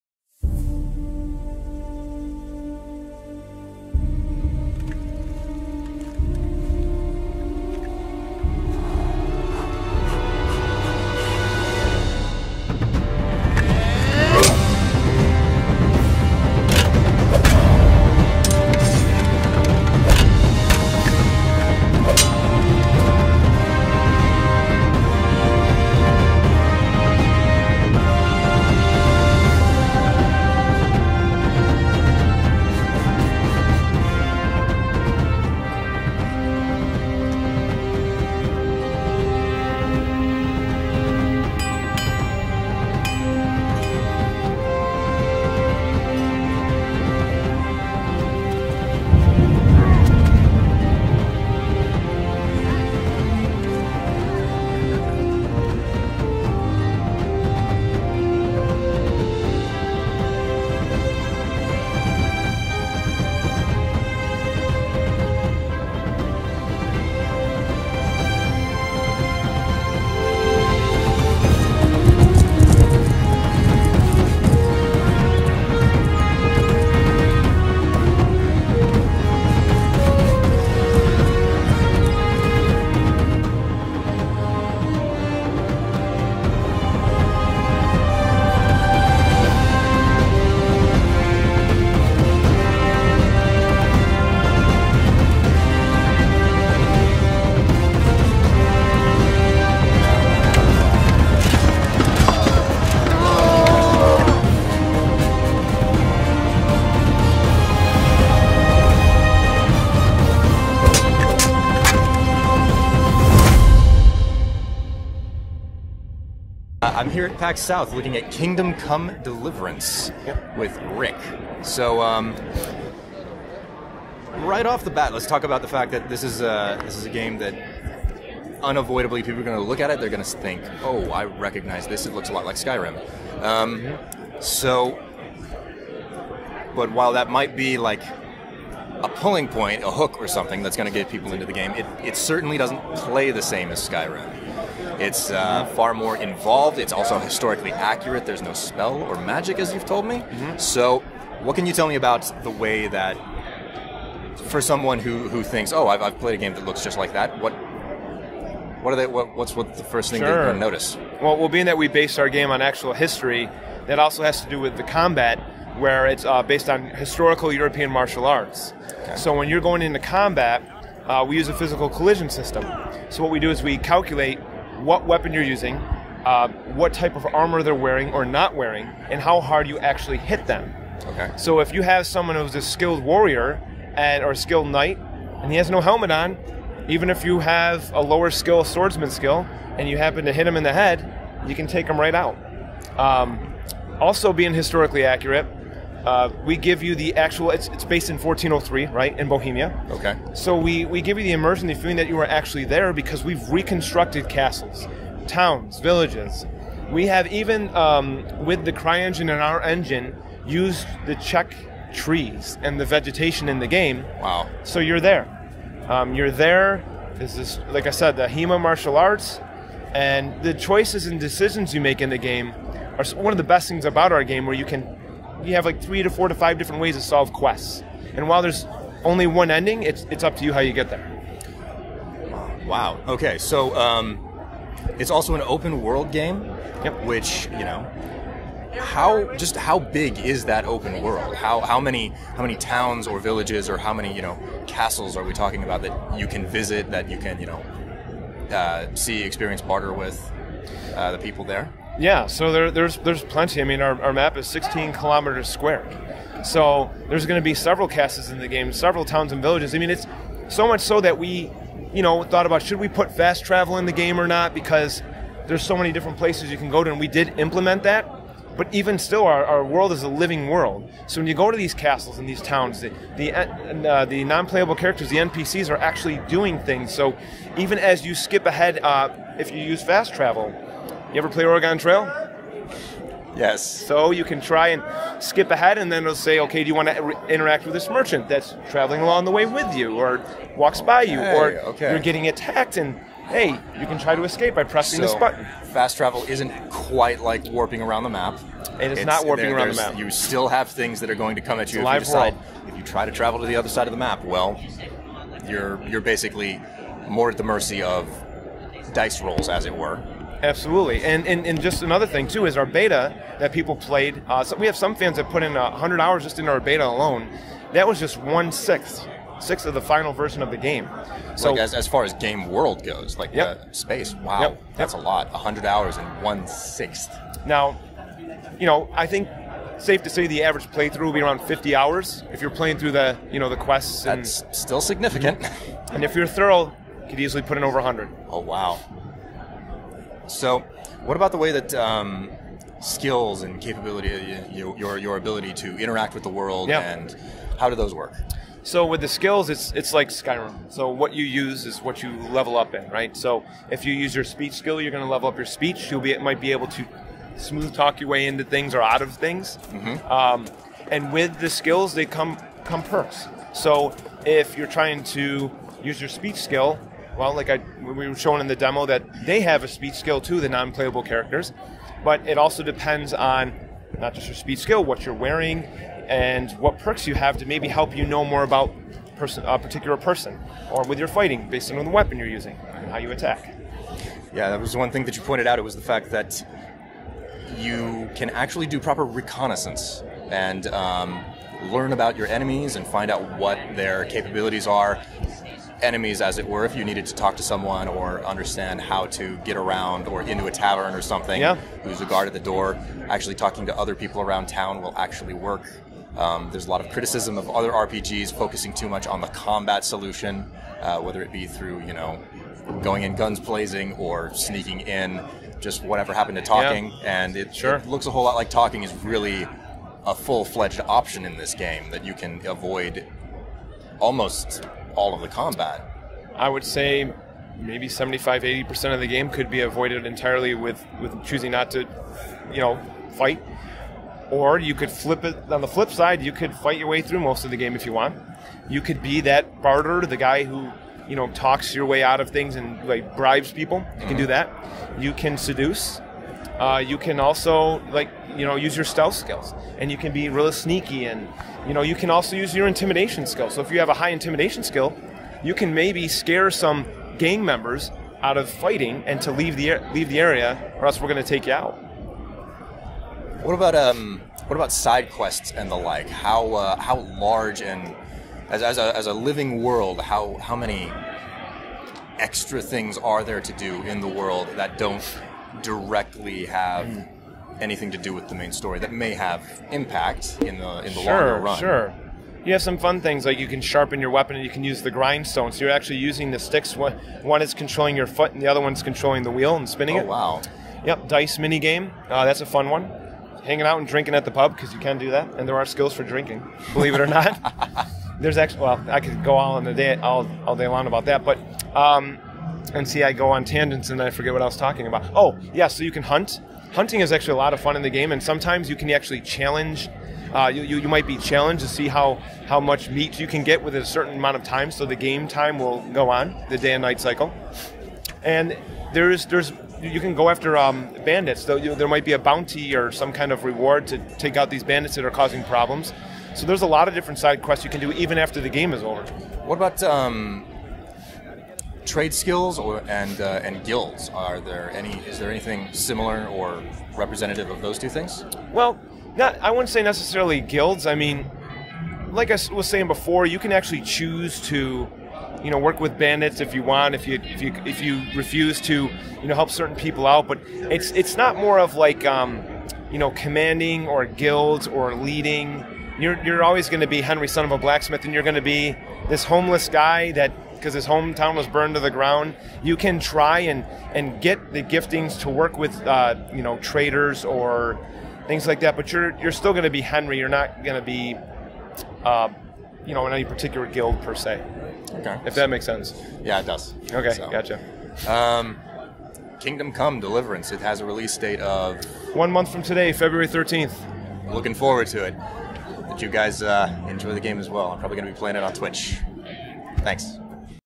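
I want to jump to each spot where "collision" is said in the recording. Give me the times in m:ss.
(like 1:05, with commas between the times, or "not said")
2:51.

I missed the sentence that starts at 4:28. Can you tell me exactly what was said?
But even still, our, our world is a living world.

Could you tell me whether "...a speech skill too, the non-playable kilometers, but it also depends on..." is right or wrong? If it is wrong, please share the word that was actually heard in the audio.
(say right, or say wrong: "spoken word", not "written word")
wrong: "characters", not "kilometers".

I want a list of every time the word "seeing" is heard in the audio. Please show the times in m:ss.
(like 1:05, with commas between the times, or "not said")
not said.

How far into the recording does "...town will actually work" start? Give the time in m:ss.
6:44.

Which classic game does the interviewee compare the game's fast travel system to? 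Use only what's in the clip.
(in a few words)
Oregon Trail.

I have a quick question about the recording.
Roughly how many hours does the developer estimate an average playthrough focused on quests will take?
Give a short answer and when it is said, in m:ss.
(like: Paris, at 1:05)
50 hours, at 5:31.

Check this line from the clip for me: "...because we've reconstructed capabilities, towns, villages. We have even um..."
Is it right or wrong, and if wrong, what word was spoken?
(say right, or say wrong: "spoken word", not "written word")
wrong: "castles", not "capabilities".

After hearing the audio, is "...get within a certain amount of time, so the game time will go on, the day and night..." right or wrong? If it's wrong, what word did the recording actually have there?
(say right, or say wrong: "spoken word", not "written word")
right.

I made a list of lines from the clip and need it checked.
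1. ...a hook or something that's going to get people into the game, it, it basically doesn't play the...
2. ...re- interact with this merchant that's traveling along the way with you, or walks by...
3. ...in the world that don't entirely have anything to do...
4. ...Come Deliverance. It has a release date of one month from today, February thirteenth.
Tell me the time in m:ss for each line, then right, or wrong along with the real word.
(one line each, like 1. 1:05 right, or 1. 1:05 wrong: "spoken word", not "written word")
1. 2:19 wrong: "certainly", not "basically"
2. 4:47 right
3. 7:53 wrong: "directly", not "entirely"
4. 9:39 right.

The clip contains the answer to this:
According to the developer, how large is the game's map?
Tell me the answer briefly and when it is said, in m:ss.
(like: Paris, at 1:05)
16 kilometers square, at 4:14.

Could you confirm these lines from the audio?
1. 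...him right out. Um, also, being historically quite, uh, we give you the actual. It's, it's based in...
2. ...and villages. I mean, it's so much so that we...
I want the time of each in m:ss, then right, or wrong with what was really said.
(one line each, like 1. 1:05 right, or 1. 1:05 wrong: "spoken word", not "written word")
1. 3:11 wrong: "accurate", not "quite"
2. 4:19 right.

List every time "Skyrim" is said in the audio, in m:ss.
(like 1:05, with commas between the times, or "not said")
2:12, 2:23, 5:50.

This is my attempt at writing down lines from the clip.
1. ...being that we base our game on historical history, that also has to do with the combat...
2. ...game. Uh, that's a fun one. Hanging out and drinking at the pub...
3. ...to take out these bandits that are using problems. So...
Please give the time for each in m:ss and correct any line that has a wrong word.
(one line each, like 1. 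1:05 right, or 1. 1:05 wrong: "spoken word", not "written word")
1. 2:41 wrong: "actual", not "historical"
2. 8:11 right
3. 8:43 wrong: "causing", not "using".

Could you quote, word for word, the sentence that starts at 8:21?
Um, and see, I go on tangents and I forget what I was talking about.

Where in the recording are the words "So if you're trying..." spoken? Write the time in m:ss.
6:03.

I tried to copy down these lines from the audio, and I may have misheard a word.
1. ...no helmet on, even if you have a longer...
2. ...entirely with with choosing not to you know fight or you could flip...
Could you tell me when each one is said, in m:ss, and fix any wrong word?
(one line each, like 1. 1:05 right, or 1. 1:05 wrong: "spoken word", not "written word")
1. 3:05 wrong: "lower", not "longer"
2. 7:10 right.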